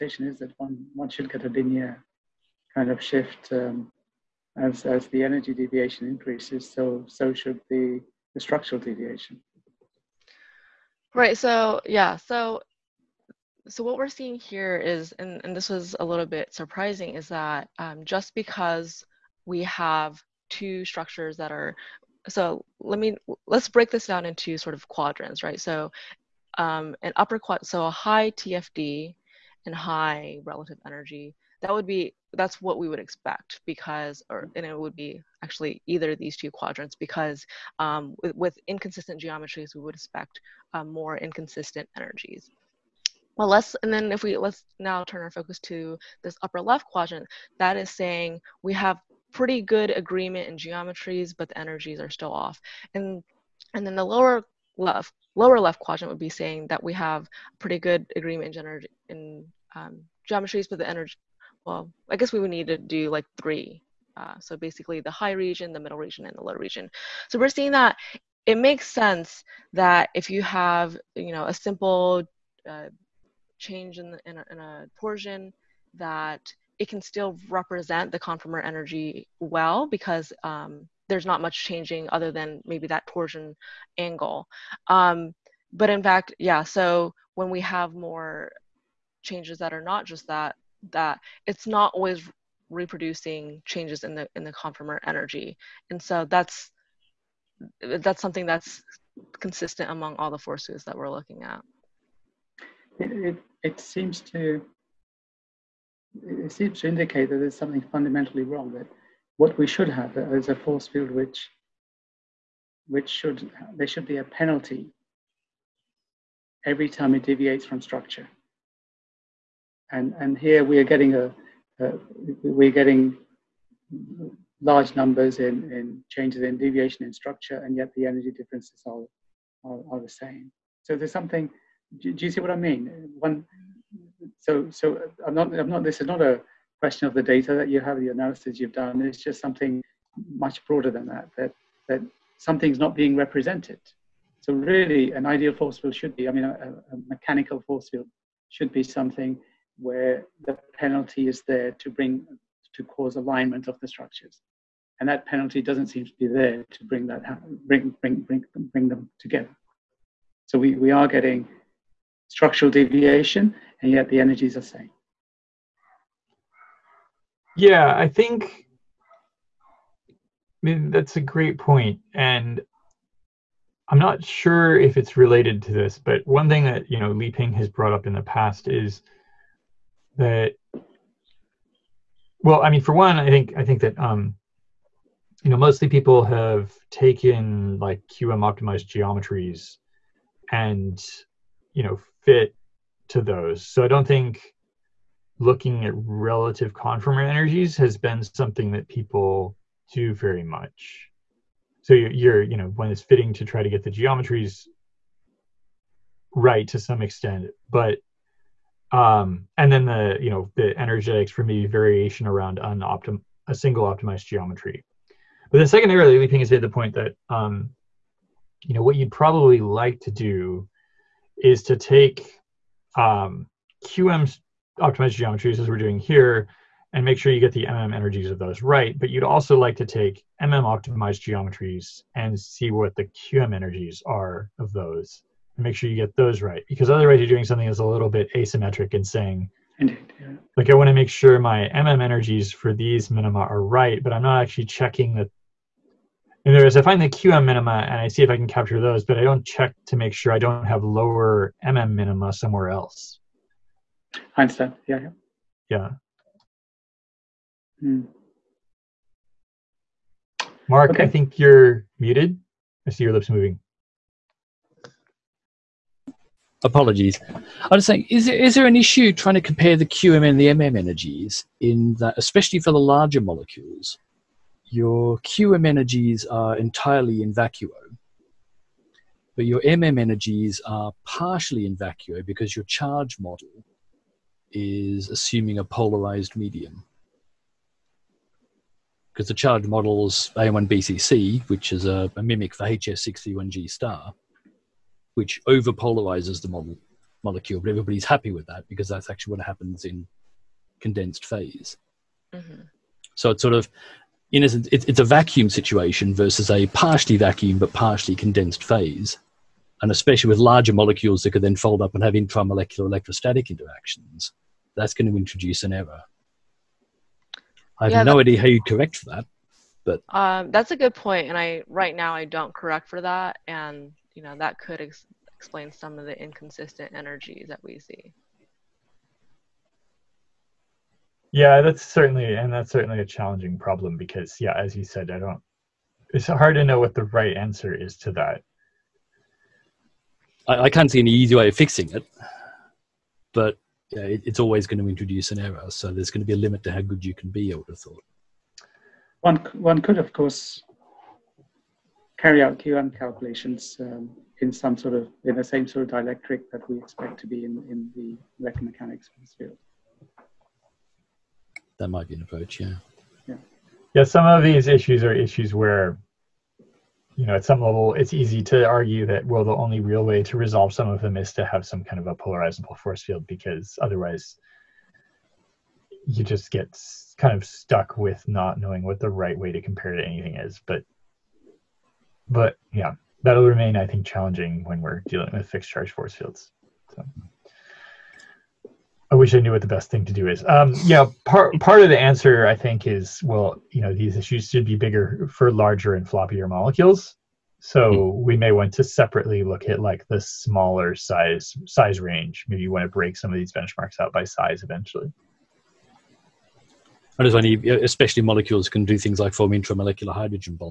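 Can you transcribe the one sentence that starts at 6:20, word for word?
But, but yeah, that'll remain, I think, challenging when we're dealing with fixed charge force fields.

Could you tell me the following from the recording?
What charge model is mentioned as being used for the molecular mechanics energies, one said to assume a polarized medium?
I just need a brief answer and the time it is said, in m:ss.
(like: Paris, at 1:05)
AM1BCC, at 4:50.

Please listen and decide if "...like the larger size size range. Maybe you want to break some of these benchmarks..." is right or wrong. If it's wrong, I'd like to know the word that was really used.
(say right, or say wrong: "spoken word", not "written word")
wrong: "smaller", not "larger".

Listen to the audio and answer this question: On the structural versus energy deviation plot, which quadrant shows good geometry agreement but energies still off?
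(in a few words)
upper left.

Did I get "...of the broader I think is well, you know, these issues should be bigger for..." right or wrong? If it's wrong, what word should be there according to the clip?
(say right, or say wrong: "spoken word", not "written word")
wrong: "answer", not "broader".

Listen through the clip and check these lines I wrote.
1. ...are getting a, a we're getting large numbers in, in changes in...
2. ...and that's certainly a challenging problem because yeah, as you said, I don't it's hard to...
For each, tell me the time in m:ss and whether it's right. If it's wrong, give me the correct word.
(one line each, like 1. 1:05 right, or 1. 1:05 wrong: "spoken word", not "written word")
1. 2:00 right
2. 5:32 right.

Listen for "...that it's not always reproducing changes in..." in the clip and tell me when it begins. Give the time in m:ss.
1:30.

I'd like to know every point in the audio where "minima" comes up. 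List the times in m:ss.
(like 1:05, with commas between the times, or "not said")
4:03, 4:07, 4:11.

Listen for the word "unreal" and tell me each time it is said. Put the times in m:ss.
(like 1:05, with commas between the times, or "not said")
not said.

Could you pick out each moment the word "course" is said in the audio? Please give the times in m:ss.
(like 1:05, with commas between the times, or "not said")
5:50.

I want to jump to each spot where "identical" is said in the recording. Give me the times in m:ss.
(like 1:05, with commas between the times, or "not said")
not said.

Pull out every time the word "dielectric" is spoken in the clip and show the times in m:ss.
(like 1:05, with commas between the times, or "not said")
5:55.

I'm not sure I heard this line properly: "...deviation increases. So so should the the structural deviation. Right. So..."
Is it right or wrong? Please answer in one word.
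right.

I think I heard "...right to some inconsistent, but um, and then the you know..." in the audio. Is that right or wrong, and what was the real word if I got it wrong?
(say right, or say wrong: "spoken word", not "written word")
wrong: "extent", not "inconsistent".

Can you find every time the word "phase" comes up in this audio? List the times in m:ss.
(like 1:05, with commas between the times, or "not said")
5:01, 5:08.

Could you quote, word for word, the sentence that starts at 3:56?
Because otherwise, you're doing something that's a little bit asymmetric and saying, Indeed, yeah.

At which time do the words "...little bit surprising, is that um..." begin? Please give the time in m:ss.
0:16.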